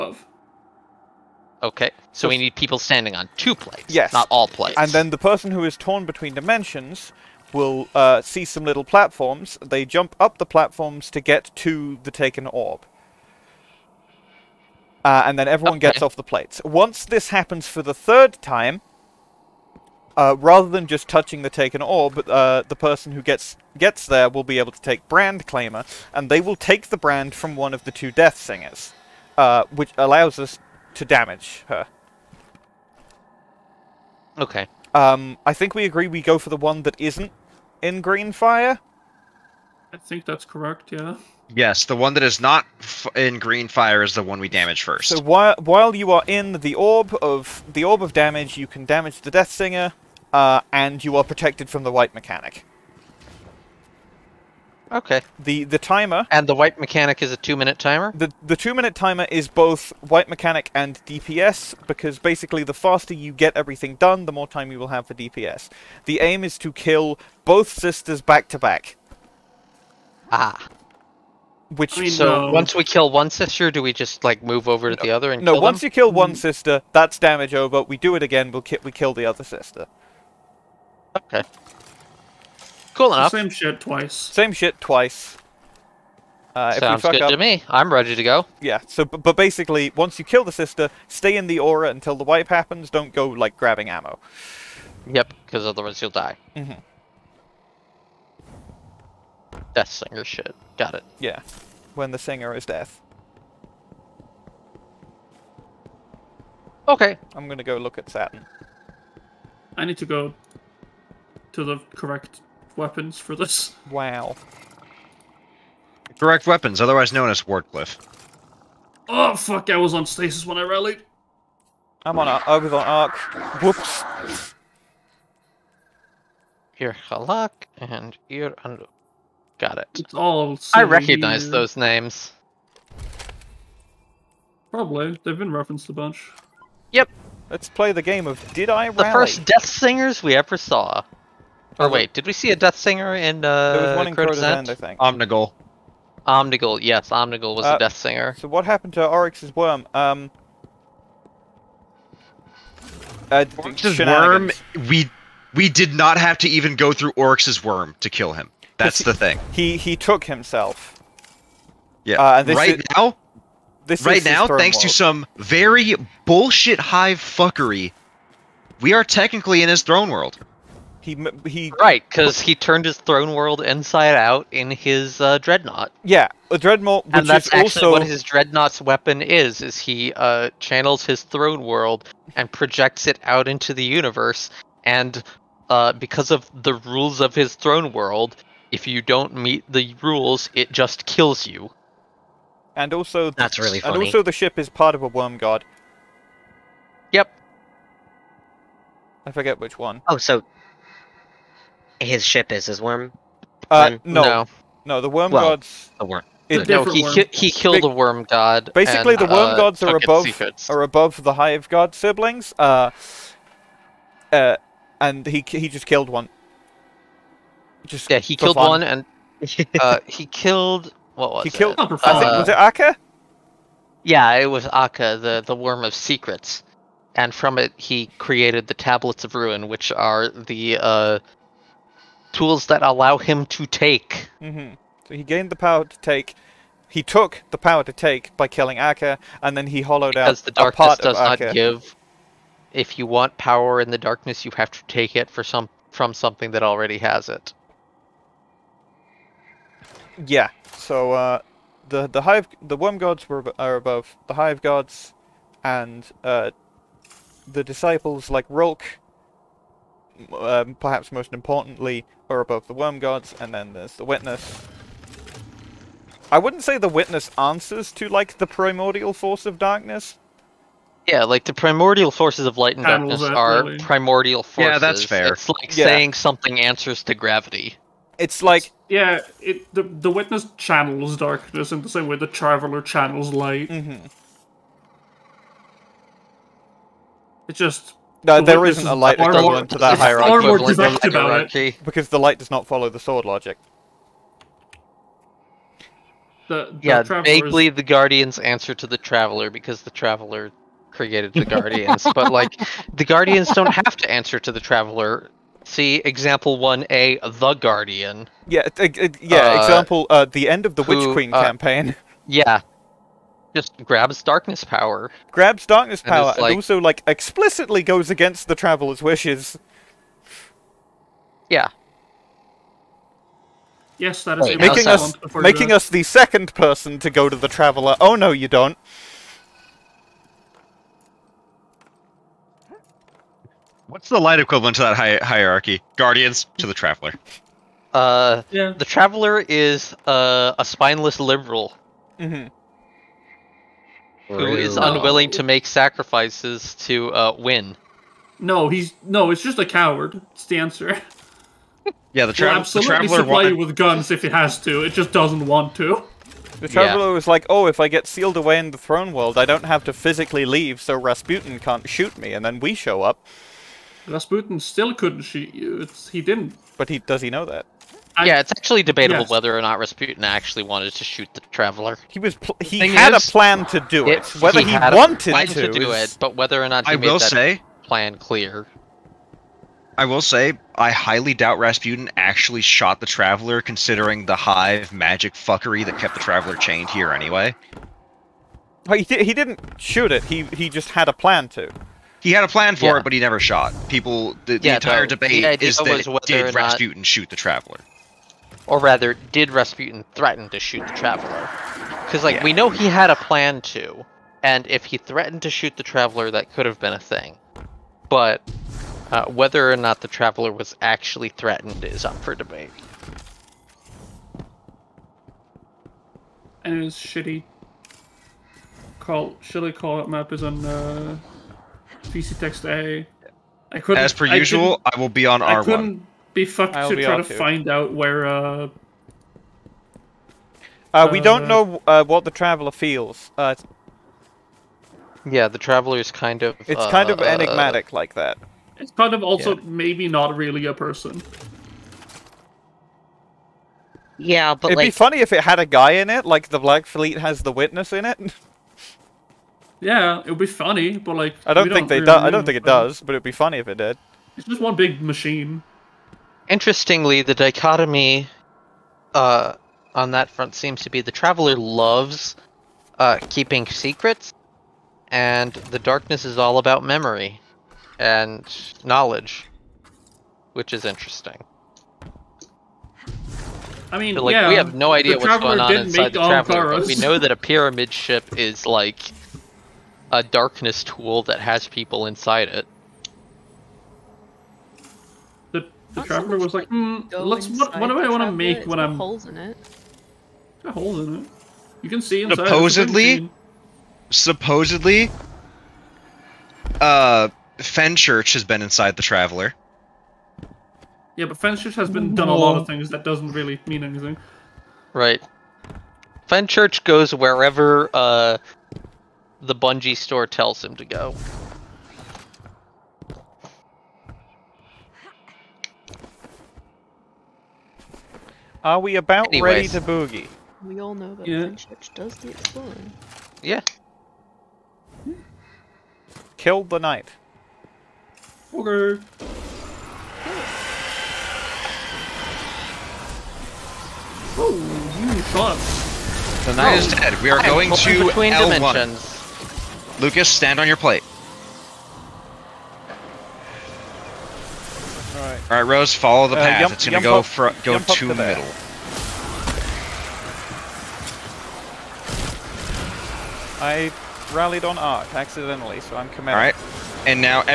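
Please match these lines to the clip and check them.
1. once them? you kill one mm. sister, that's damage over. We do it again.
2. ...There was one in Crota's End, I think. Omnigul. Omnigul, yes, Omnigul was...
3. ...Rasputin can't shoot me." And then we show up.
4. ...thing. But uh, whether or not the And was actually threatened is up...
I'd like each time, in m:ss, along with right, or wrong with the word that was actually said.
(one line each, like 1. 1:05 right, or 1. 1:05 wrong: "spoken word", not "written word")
1. 1:15 right
2. 2:23 right
3. 6:00 right
4. 6:46 wrong: "Traveler", not "And".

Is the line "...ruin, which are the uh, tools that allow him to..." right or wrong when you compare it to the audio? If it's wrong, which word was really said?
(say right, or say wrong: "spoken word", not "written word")
right.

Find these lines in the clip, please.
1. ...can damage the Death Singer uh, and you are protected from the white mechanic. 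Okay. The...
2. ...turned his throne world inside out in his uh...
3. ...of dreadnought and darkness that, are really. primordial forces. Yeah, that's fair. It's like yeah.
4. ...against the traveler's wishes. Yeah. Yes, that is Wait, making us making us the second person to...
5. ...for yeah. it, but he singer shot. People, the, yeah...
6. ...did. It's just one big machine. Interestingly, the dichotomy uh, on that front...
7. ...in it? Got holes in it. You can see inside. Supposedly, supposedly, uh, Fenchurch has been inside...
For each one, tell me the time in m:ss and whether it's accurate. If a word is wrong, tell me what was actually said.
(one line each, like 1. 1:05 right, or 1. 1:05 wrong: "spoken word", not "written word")
1. 0:48 right
2. 2:52 right
3. 4:32 wrong: "light", not "dreadnought"
4. 5:18 right
5. 6:32 wrong: "never", not "singer"
6. 7:33 right
7. 8:09 right.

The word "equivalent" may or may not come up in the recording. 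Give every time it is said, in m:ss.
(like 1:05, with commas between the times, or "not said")
4:49, 5:34.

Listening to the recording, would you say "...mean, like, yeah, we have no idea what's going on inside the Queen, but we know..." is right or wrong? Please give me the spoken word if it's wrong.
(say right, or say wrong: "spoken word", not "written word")
wrong: "Traveler", not "Queen".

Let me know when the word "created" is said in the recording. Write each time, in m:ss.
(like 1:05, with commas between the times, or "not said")
3:48, 5:00.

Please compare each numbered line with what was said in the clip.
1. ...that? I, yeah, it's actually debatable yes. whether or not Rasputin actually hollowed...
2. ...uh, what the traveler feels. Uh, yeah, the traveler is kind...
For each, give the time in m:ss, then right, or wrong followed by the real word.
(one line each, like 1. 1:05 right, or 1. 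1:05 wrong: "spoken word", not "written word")
1. 6:07 wrong: "wanted", not "hollowed"
2. 7:11 right.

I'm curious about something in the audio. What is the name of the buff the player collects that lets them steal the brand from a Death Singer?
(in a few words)
Brand Claimer.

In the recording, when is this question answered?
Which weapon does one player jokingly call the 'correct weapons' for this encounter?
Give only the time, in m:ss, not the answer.
1:57.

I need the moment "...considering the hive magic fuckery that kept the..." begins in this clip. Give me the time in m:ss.
6:23.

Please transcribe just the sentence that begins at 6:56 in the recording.
And his shitty call, shitty call out map is on uh, VC text A.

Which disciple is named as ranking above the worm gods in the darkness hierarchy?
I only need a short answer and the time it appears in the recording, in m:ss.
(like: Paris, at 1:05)
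Rhulk, at 4:18.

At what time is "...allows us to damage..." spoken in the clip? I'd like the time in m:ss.
0:29.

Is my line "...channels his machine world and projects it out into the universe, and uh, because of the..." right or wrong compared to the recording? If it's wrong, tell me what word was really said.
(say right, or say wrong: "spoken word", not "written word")
wrong: "throne", not "machine".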